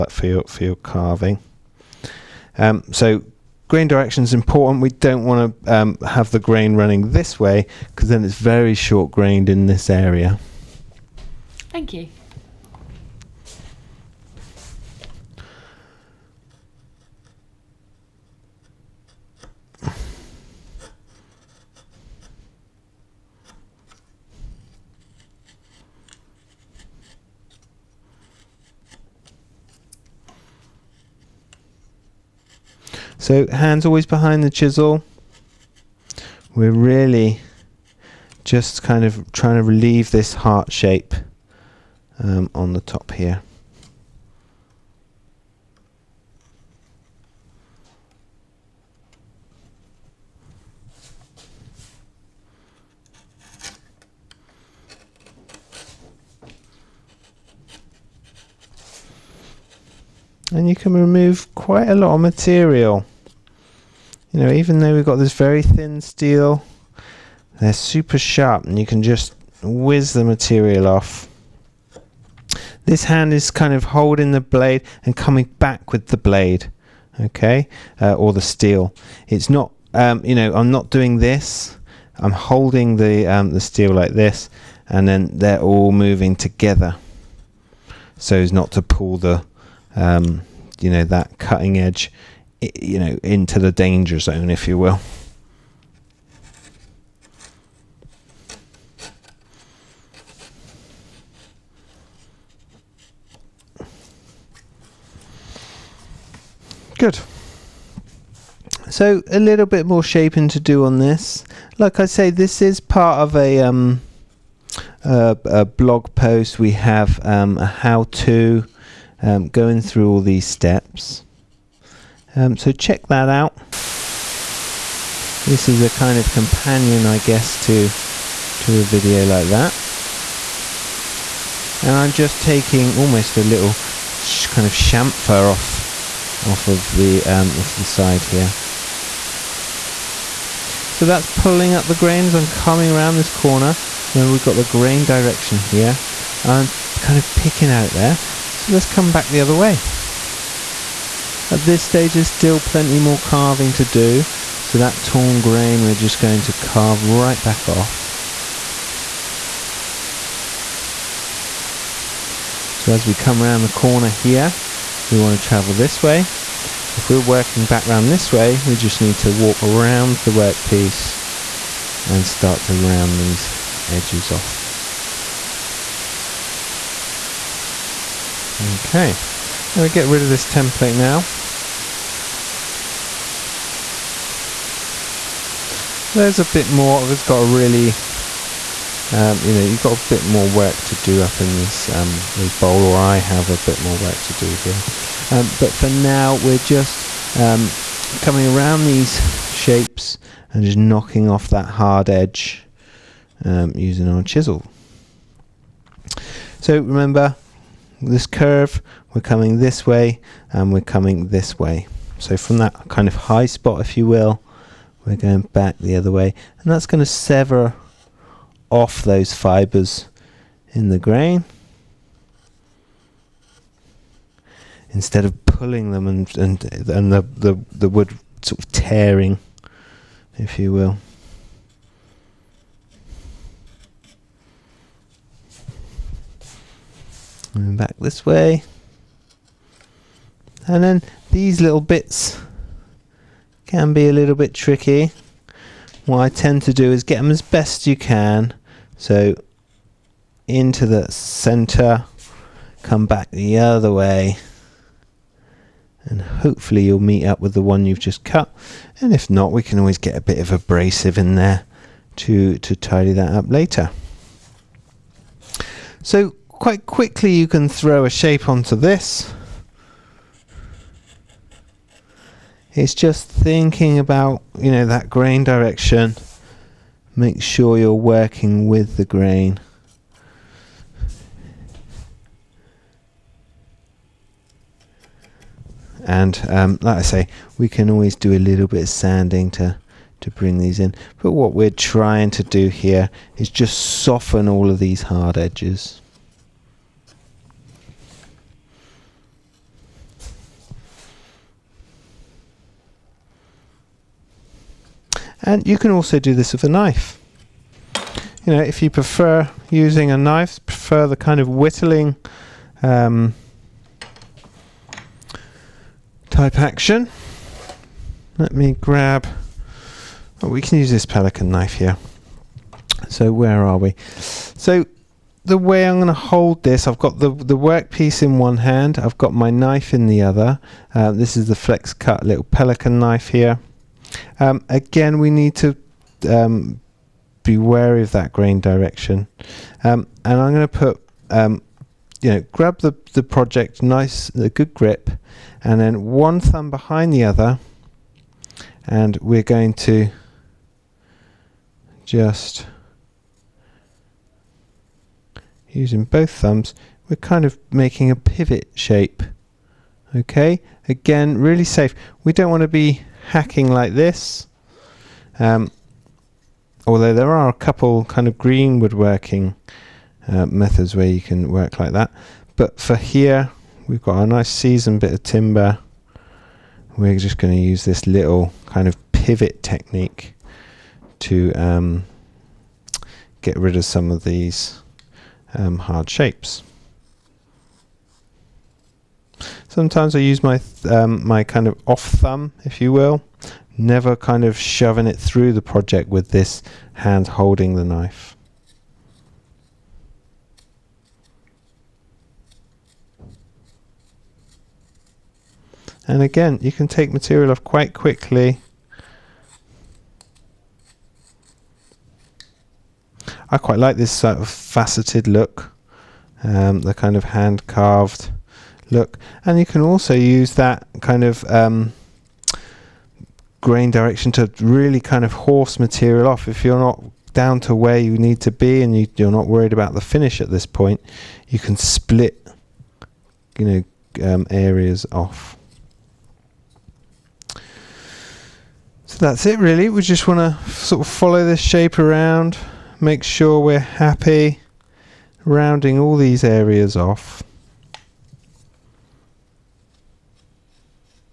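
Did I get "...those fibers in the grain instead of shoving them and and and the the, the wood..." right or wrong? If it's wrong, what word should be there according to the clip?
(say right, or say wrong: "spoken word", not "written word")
wrong: "pulling", not "shoving".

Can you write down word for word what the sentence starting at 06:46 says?
And again, you can take material off quite quickly.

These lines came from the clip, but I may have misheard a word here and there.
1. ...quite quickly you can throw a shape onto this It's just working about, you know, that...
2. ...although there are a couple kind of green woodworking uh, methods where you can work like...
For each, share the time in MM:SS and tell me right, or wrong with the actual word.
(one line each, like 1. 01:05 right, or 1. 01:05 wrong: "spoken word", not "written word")
1. 04:26 wrong: "thinking", not "working"
2. 06:06 right.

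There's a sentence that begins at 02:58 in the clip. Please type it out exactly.
Okay, I'm going to get rid of this template now.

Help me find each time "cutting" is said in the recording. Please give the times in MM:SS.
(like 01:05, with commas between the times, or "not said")
01:31.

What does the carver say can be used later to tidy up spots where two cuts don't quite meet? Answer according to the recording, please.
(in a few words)
Abrasive.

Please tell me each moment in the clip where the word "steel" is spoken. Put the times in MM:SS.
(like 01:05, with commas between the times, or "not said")
01:05, 01:18, 01:23.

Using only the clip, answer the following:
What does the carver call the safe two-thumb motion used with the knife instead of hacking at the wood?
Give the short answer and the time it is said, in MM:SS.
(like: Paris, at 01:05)
Pivot technique, at 06:19.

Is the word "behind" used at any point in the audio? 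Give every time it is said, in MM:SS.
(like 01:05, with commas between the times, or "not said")
00:34, 05:46.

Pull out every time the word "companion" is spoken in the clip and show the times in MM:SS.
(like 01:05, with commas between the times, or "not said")
02:06.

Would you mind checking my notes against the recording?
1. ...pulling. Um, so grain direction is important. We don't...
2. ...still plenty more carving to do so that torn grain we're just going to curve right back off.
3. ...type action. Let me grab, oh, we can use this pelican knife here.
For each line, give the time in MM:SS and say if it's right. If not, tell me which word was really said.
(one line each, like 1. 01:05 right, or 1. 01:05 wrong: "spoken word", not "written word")
1. 00:00 wrong: "carving", not "pulling"
2. 02:32 wrong: "carve", not "curve"
3. 05:16 right.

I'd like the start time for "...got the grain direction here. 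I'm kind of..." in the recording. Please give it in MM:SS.
02:24.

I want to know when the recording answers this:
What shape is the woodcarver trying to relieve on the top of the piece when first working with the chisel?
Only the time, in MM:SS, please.
00:40.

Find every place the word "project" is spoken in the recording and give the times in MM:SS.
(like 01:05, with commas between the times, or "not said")
05:43, 06:35.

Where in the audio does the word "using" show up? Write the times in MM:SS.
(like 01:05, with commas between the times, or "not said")
03:23, 05:09, 05:55.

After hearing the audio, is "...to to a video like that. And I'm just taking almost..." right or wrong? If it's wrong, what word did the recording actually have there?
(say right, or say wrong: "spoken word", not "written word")
right.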